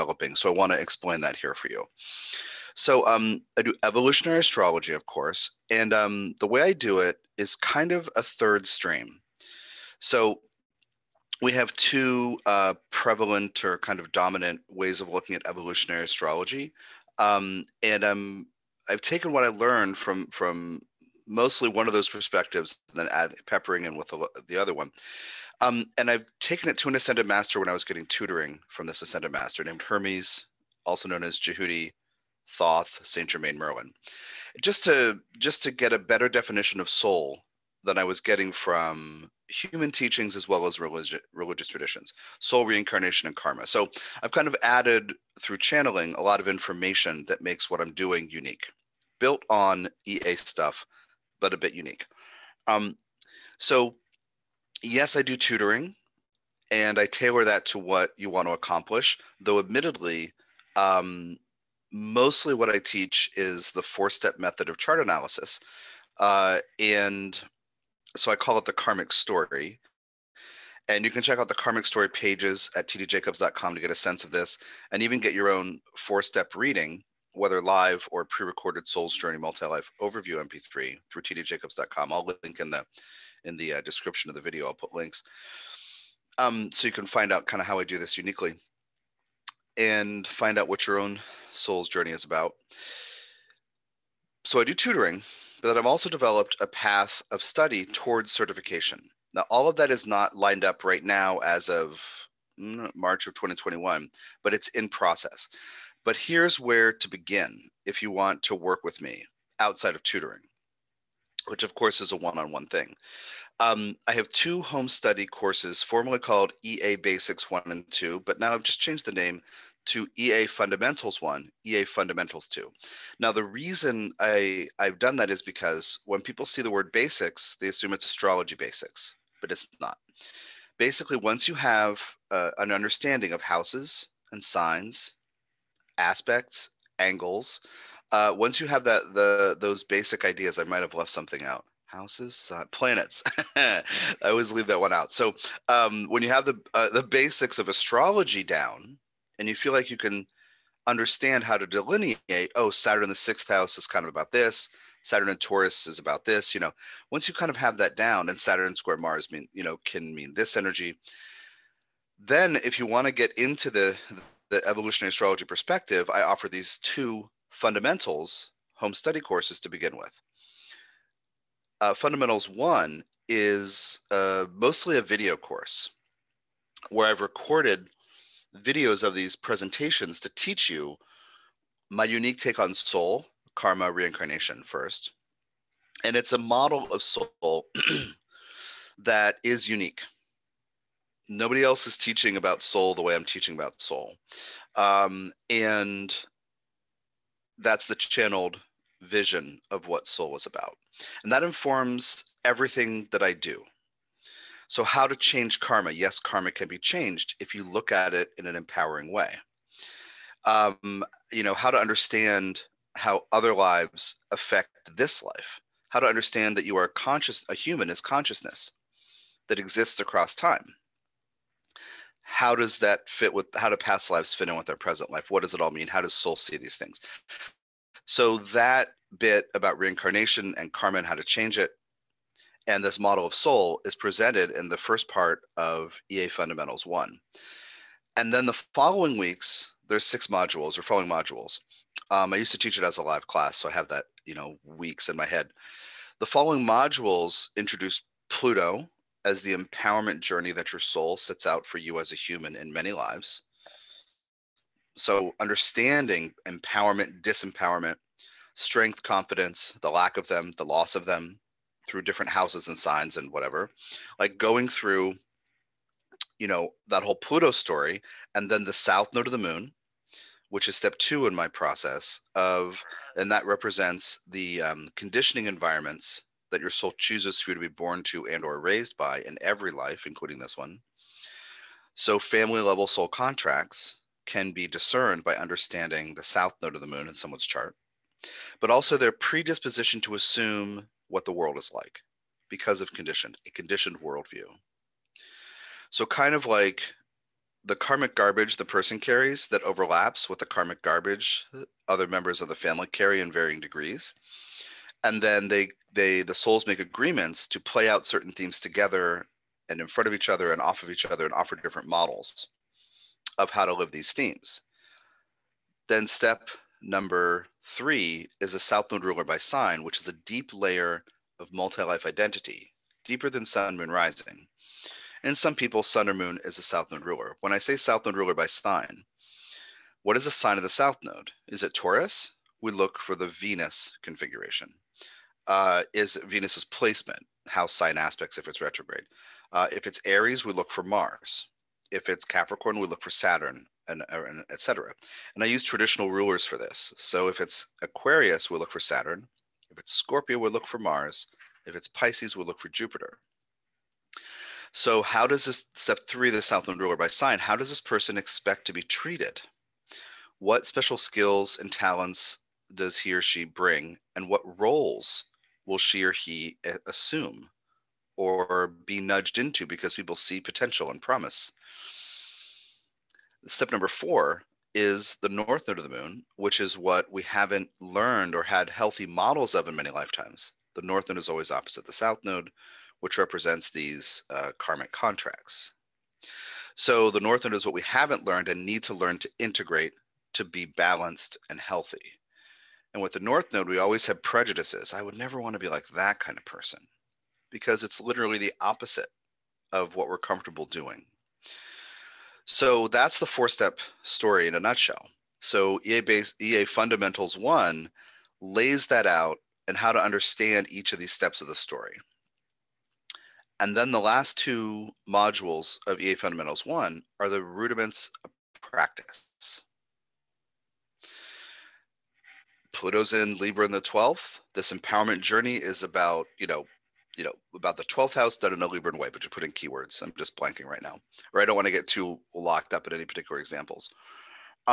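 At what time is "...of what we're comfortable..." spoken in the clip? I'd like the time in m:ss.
6:39.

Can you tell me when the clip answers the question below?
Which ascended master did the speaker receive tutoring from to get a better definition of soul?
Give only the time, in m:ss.
0:29.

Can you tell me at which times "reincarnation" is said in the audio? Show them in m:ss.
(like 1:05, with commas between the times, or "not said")
0:42, 3:03, 3:49.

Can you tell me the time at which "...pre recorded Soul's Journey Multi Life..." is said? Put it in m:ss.
1:18.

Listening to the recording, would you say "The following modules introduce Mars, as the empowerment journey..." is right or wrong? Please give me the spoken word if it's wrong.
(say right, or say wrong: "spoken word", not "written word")
wrong: "Pluto", not "Mars".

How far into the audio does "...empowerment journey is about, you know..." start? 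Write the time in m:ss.
7:04.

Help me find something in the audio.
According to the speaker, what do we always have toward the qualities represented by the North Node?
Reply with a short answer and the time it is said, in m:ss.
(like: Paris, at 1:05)
Prejudices, at 6:34.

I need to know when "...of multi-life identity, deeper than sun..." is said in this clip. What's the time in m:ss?
5:21.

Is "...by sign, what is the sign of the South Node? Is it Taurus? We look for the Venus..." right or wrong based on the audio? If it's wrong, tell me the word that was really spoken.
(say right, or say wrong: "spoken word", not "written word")
right.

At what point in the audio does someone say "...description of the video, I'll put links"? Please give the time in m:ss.
1:23.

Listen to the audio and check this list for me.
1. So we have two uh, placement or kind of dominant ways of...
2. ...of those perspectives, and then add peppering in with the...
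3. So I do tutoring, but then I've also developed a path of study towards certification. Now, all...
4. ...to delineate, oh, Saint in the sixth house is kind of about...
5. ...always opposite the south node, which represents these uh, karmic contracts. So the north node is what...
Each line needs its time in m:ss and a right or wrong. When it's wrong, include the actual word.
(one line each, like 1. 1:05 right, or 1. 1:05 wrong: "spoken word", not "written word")
1. 0:09 wrong: "prevalent", not "placement"
2. 0:21 right
3. 1:34 right
4. 2:31 wrong: "Saturn", not "Saint"
5. 6:21 right.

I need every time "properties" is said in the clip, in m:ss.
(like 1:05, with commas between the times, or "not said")
not said.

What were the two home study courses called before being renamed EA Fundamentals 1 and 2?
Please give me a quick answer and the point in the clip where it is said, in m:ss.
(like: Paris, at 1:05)
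EA Basics 1 and 2, at 1:56.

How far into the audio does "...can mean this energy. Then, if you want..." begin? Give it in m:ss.
2:39.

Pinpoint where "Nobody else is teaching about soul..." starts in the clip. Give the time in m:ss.
3:11.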